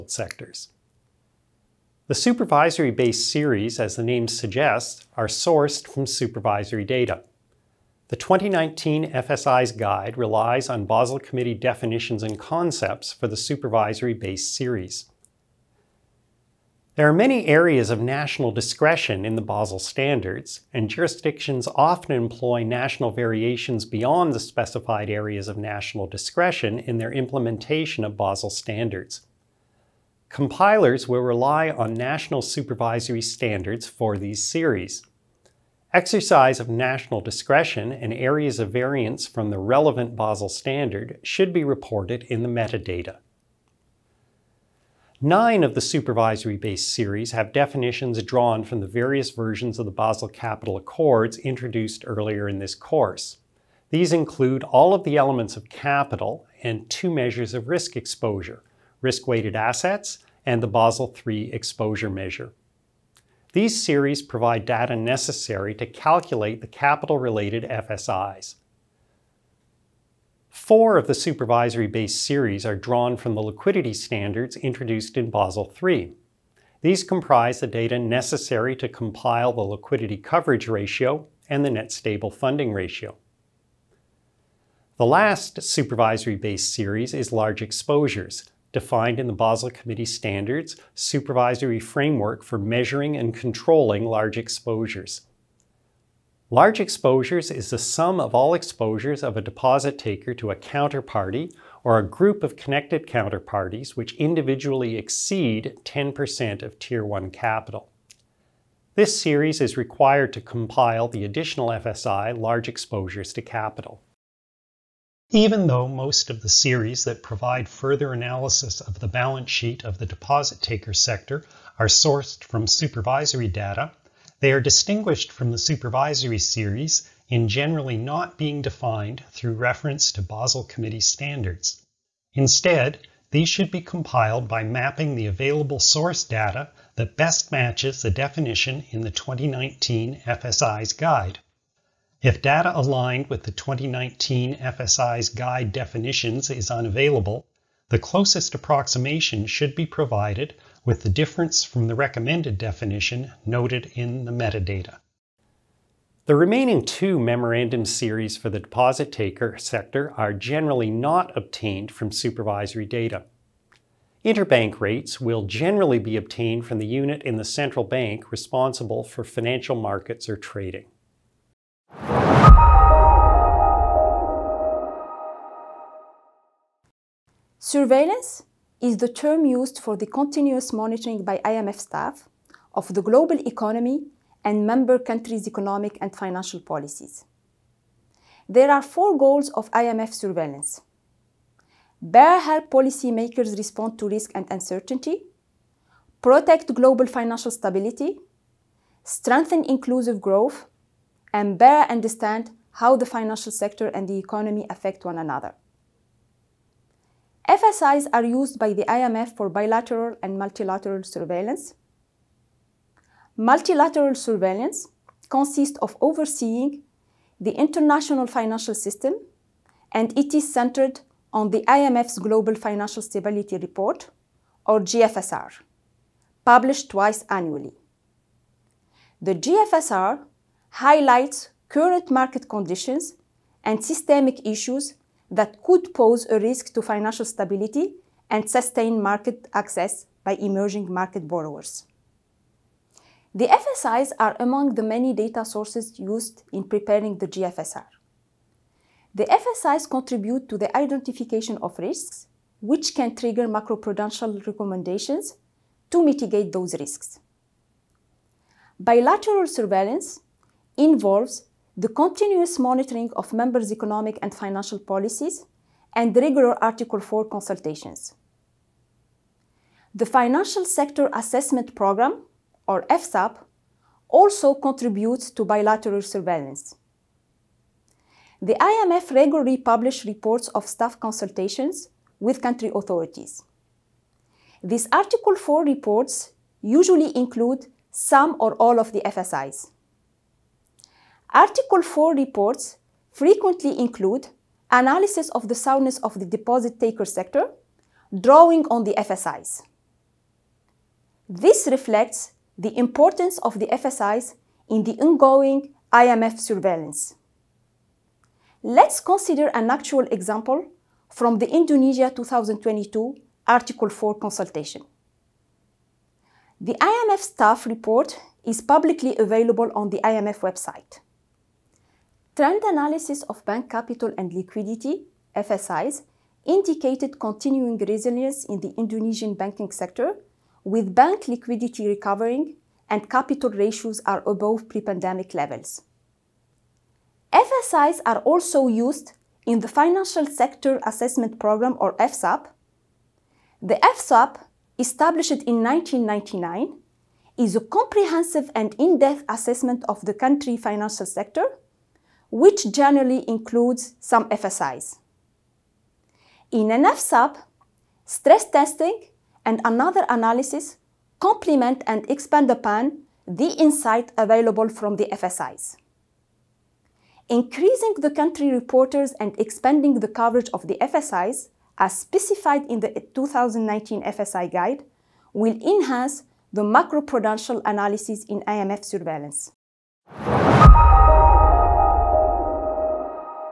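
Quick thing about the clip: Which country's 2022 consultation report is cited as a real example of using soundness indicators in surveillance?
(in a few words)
Indonesia.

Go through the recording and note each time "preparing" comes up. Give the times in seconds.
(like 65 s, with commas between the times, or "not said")
246 s.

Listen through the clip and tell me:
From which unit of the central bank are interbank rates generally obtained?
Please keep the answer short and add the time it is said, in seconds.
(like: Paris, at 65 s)
Financial markets or trading, at 169 s.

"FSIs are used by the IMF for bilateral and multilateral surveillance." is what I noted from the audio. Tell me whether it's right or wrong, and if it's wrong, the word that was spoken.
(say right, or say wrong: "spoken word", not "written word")
right.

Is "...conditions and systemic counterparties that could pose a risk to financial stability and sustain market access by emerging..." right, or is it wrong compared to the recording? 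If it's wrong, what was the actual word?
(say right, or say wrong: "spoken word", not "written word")
wrong: "issues", not "counterparties".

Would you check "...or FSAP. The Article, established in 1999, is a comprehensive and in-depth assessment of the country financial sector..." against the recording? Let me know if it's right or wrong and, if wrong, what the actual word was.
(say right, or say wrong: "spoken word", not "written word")
wrong: "FSAP", not "Article".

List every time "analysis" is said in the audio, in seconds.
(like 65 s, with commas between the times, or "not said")
118 s, 294 s, 322 s, 360 s, 377 s.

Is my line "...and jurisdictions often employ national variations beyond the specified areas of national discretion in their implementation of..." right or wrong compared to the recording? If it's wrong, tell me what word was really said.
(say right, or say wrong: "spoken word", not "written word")
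right.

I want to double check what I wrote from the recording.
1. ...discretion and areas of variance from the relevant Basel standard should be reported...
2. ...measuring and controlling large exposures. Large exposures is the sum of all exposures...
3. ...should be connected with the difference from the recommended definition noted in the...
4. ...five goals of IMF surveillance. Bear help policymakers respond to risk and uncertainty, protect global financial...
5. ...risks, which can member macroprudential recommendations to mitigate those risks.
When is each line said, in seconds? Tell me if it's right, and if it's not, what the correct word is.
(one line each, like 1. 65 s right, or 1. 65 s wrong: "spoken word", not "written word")
1. 37 s right
2. 92 s right
3. 149 s wrong: "provided", not "connected"
4. 188 s wrong: "four", not "five"
5. 251 s wrong: "trigger", not "member".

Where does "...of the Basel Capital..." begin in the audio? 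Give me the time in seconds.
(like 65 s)
49 s.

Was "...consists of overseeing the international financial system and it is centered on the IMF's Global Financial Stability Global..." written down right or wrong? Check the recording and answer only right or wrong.
wrong.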